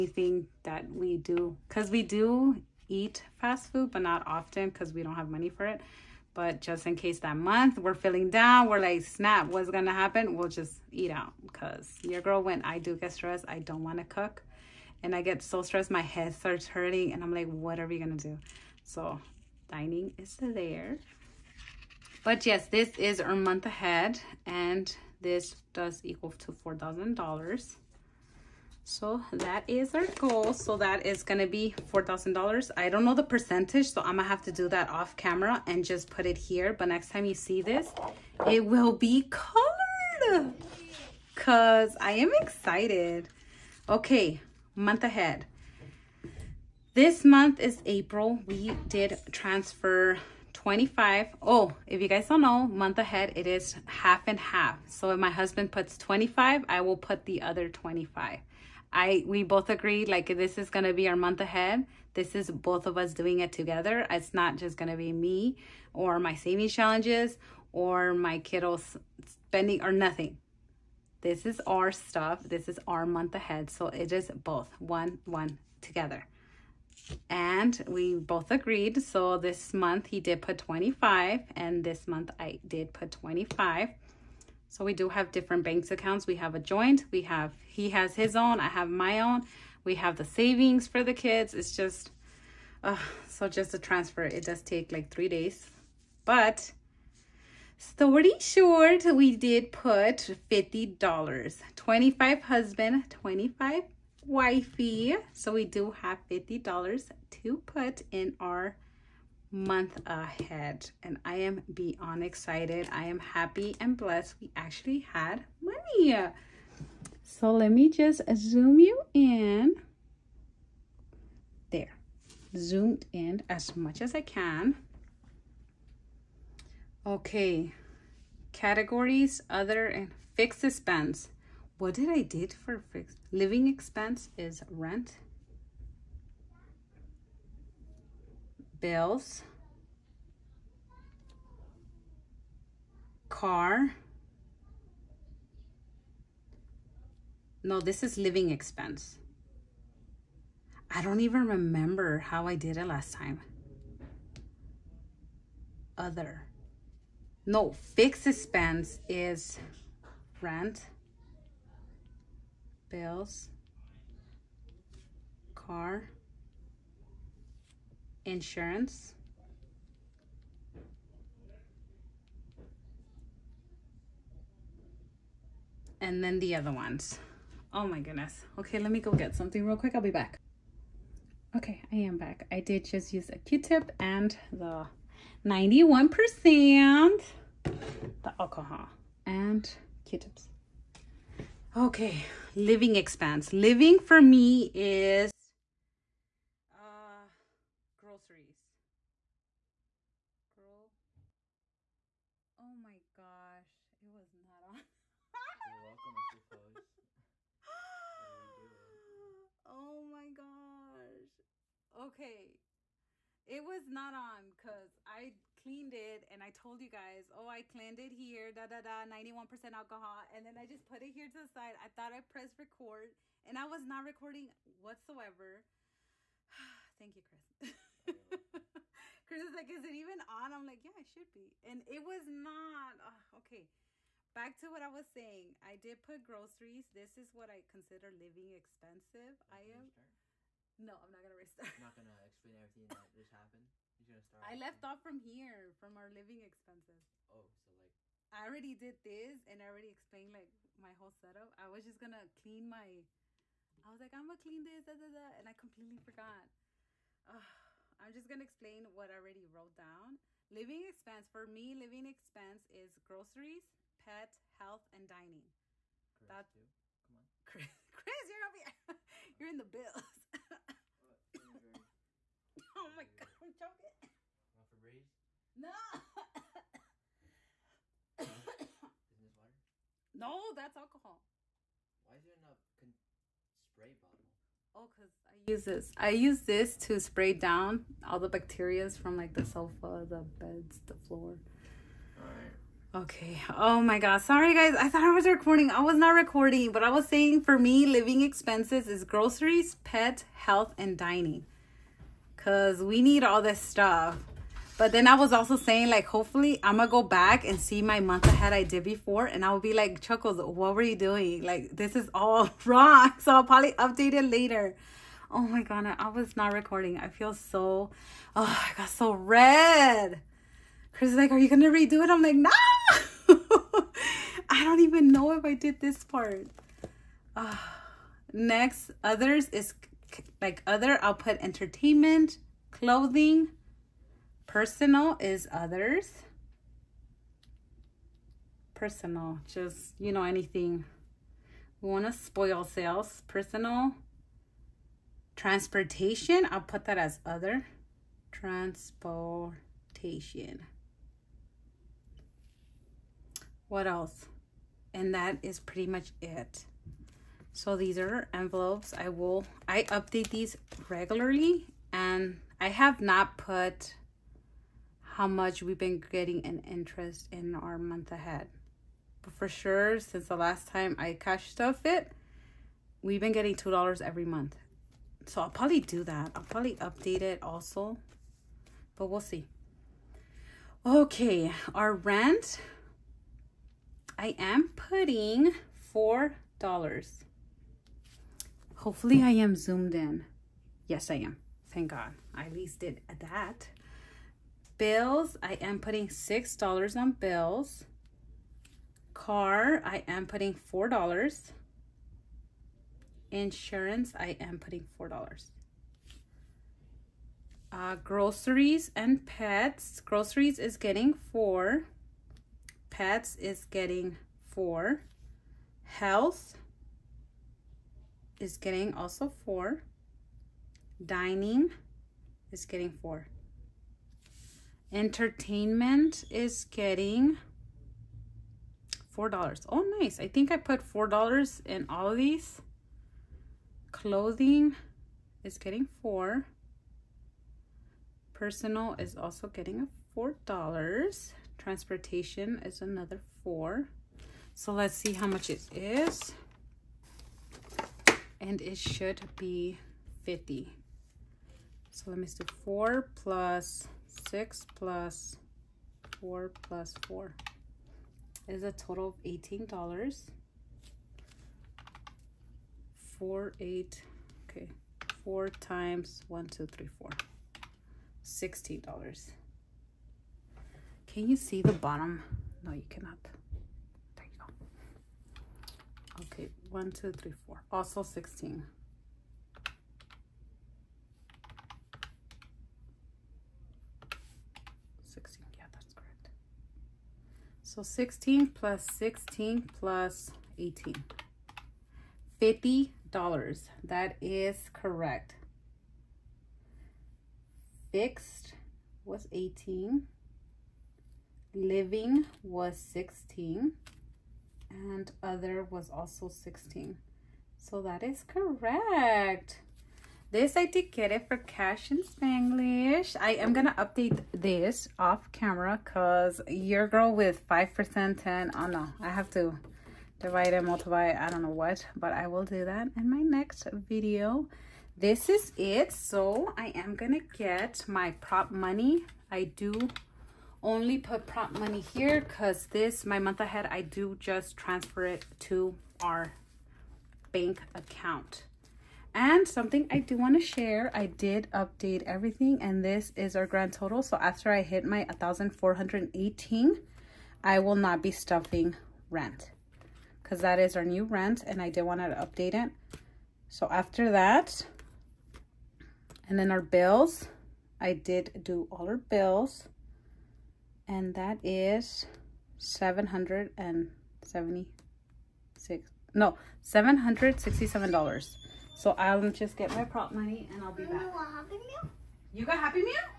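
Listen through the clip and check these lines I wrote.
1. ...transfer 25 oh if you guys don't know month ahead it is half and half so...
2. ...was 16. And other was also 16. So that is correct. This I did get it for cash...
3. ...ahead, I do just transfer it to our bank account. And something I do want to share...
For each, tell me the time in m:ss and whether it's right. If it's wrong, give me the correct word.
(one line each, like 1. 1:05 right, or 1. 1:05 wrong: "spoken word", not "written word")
1. 0:49 right
2. 8:22 right
3. 8:53 right.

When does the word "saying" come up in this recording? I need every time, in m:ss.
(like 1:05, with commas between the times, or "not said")
3:55, 4:57, 5:05.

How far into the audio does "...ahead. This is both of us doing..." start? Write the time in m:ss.
1:01.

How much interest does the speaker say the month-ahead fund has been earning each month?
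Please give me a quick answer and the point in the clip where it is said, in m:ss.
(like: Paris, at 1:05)
$2, at 6:13.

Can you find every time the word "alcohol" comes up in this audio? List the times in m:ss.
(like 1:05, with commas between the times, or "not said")
3:08, 3:39, 4:40.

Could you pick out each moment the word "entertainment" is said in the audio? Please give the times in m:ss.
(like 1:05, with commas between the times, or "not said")
5:31, 7:04.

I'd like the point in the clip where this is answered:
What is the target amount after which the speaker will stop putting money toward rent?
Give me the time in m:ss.
9:05.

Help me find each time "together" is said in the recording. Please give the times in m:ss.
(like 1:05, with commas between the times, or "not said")
1:03, 1:15.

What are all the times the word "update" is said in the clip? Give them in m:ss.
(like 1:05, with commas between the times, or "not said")
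5:13, 5:59, 6:16, 8:33, 9:01, 9:12.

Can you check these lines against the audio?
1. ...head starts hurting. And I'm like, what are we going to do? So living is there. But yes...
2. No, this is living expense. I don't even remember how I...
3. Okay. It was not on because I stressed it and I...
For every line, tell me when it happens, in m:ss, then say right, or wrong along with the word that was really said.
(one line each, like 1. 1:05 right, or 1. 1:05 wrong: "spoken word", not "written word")
1. 0:16 wrong: "dining", not "living"
2. 2:27 right
3. 3:31 wrong: "cleaned", not "stressed".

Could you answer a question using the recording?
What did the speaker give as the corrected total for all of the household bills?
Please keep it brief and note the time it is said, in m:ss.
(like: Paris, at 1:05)
$767, at 9:26.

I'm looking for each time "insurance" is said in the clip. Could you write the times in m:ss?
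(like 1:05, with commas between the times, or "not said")
2:48, 6:43.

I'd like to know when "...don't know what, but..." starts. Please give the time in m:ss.
8:41.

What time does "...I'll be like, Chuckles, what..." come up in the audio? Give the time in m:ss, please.
5:09.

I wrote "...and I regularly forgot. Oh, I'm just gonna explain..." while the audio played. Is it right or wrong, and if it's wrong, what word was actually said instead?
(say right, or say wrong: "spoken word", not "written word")
wrong: "completely", not "regularly".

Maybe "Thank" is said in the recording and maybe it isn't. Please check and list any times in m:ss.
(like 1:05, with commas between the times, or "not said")
3:46, 6:31.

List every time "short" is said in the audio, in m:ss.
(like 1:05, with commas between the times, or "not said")
1:38.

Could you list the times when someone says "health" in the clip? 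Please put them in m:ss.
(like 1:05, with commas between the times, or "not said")
4:24, 5:00, 6:55.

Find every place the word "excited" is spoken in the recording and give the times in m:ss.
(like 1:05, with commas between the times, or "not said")
0:42, 1:52.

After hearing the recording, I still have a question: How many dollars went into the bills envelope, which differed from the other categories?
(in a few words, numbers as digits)
$6.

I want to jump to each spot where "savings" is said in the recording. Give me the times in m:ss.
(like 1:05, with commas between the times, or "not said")
1:06, 1:30.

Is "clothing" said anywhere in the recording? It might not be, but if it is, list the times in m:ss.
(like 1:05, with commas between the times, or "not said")
5:32, 7:13.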